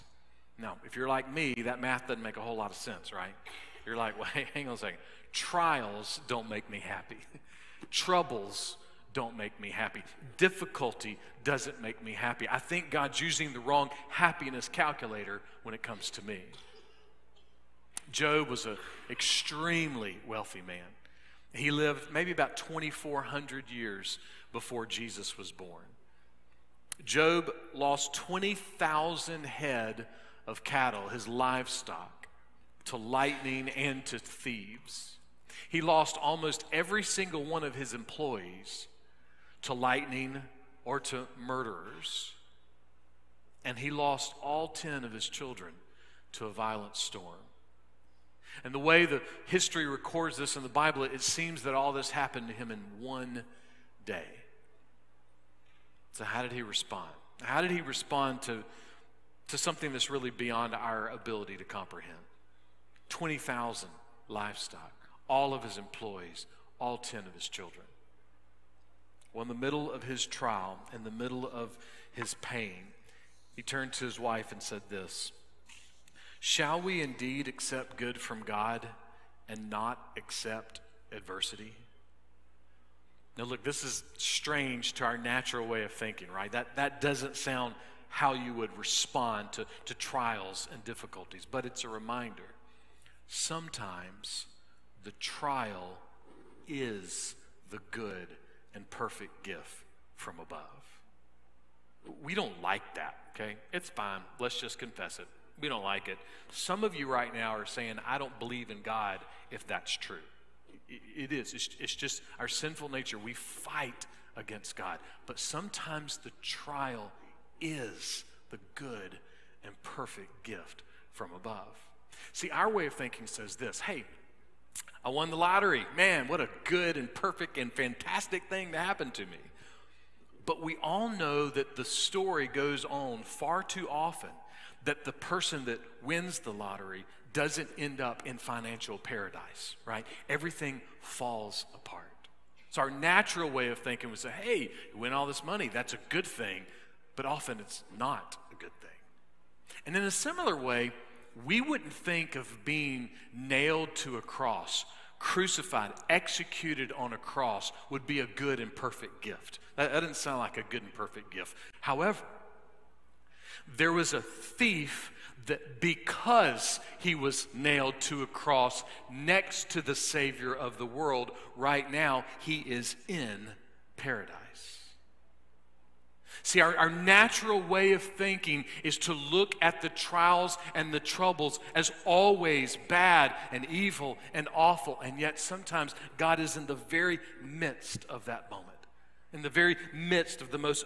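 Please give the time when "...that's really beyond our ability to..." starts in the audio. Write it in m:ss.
0:59.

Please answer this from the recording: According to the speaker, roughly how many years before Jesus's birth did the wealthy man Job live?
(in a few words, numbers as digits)
2,400.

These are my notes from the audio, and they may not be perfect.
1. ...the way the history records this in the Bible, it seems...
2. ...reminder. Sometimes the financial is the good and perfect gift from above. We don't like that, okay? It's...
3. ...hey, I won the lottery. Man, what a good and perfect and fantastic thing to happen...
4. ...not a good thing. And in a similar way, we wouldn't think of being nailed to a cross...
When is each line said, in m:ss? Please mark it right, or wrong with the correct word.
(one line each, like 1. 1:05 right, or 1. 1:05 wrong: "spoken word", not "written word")
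1. 0:48 right
2. 1:31 wrong: "trial", not "financial"
3. 2:03 right
4. 2:27 right.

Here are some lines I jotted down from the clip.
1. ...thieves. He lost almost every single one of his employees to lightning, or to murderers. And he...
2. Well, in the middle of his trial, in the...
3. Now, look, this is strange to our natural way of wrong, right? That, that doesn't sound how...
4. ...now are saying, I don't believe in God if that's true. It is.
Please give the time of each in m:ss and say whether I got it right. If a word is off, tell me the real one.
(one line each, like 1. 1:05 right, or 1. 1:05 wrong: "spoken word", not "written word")
1. 0:34 right
2. 1:09 right
3. 1:23 wrong: "thinking", not "wrong"
4. 1:47 right.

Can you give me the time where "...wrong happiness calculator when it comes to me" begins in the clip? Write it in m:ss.
0:13.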